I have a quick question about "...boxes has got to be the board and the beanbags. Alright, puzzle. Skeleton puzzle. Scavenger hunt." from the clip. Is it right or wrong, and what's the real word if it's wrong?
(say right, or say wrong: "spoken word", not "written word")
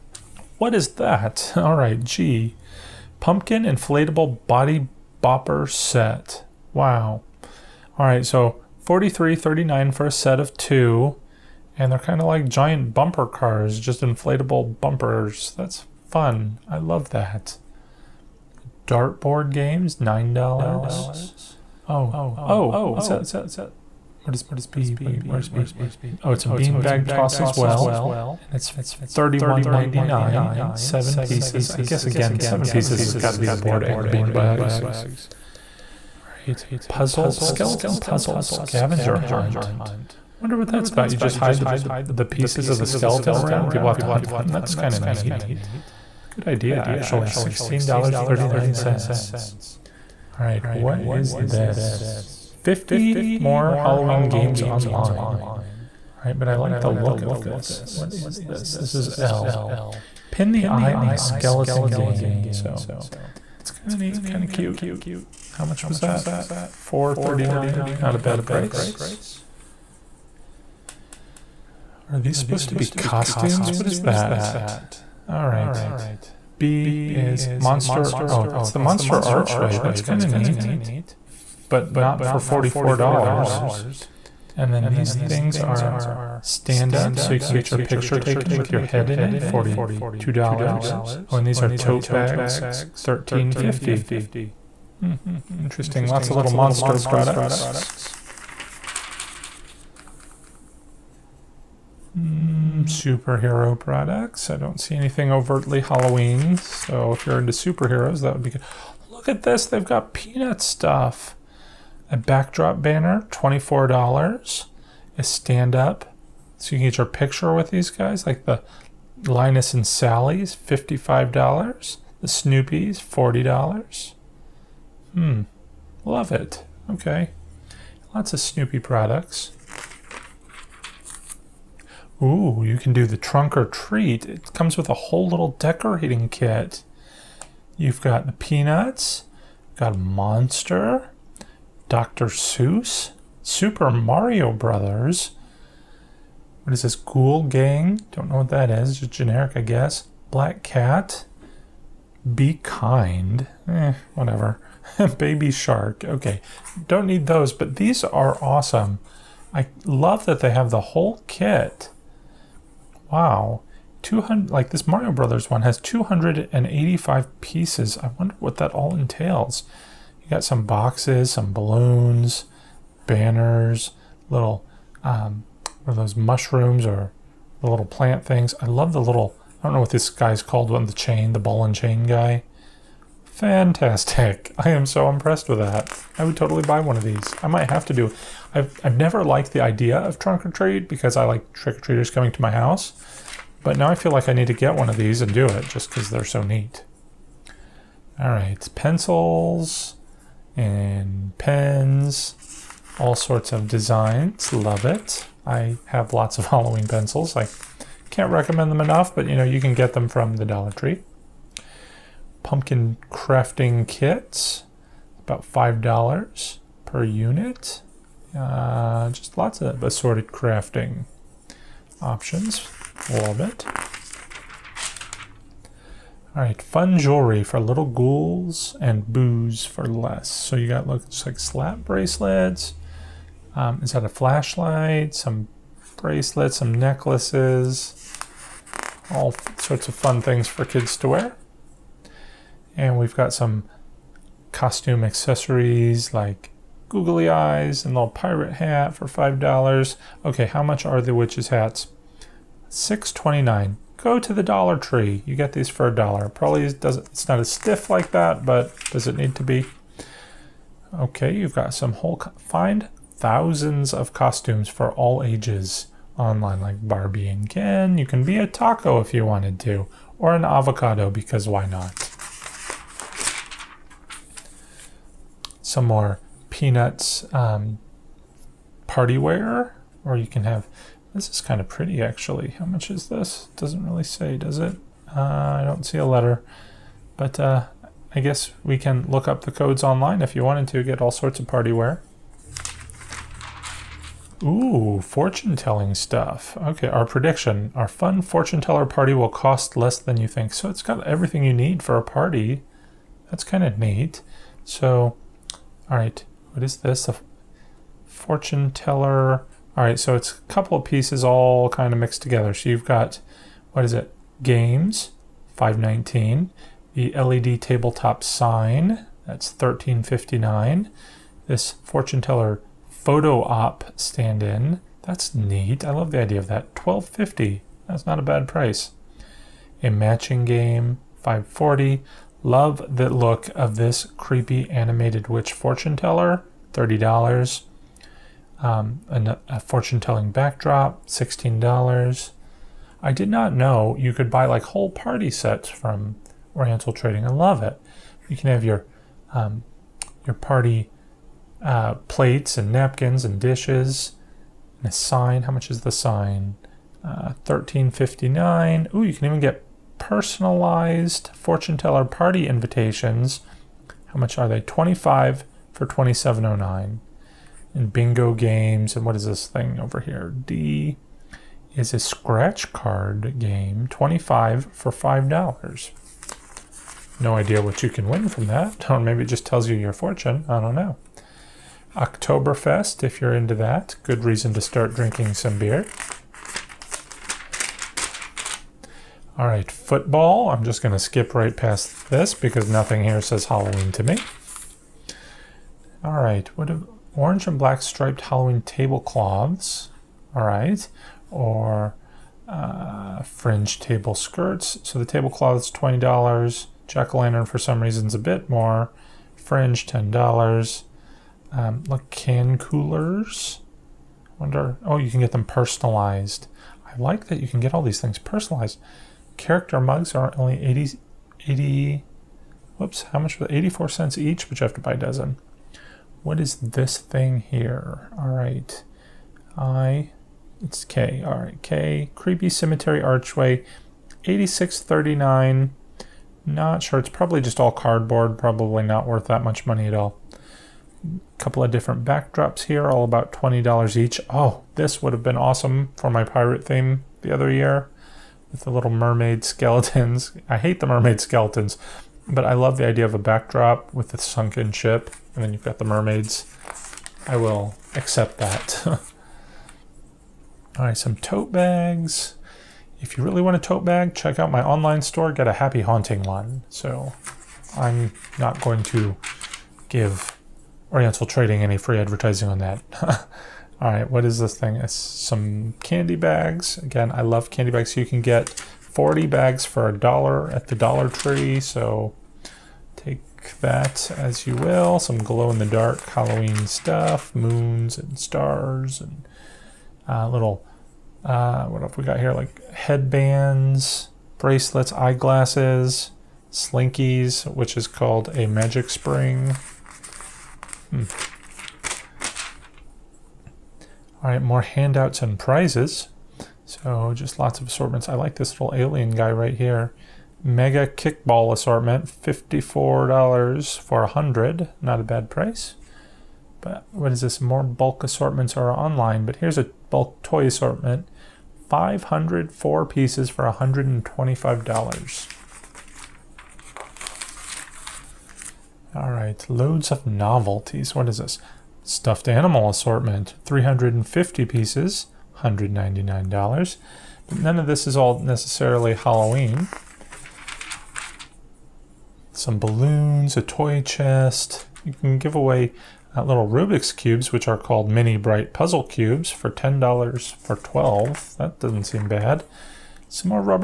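wrong: "pieces", not "boxes".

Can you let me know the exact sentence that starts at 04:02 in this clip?
And we've got some costume accessories like googly eyes and little pirate hat for $5.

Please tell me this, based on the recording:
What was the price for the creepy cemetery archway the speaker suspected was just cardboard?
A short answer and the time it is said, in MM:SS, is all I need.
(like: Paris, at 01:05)
$86.39, at 07:14.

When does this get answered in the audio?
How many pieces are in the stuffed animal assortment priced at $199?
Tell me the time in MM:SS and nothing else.
08:53.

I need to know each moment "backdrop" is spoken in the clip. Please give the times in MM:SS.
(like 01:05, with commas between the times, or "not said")
01:52, 05:40, 07:22, 07:33.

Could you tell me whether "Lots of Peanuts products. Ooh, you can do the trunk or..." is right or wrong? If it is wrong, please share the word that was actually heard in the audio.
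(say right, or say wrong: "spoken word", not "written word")
wrong: "Snoopy", not "Peanuts".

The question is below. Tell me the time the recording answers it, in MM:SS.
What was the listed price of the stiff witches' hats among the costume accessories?
04:12.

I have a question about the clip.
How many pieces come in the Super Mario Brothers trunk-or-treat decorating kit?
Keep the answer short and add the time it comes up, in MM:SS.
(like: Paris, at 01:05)
285, at 02:45.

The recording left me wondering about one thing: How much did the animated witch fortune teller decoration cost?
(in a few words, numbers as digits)
$30.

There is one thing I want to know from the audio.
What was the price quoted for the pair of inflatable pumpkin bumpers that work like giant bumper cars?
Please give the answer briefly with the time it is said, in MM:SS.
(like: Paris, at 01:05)
$43.39, at 00:08.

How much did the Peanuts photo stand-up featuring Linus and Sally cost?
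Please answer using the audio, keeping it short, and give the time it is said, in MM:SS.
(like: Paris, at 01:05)
$55, at 02:00.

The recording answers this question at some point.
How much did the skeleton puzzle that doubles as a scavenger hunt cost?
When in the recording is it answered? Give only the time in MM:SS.
00:47.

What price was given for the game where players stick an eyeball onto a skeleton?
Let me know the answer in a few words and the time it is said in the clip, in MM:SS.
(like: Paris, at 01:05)
$4.39, at 01:06.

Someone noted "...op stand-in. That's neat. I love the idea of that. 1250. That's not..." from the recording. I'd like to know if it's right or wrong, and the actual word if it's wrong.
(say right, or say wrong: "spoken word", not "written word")
right.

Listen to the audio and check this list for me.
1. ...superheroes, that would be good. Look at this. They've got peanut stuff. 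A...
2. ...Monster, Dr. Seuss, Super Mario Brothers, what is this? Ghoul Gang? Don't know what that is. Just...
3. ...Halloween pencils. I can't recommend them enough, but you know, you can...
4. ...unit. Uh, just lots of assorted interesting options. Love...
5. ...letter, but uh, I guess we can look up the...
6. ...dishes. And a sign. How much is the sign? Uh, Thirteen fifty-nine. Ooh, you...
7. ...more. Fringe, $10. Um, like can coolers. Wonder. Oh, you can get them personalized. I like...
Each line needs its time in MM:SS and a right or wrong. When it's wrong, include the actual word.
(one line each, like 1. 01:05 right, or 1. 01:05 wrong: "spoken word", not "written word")
1. 01:47 right
2. 02:19 right
3. 03:26 right
4. 03:37 wrong: "crafting", not "interesting"
5. 04:46 right
6. 05:53 right
7. 06:48 right.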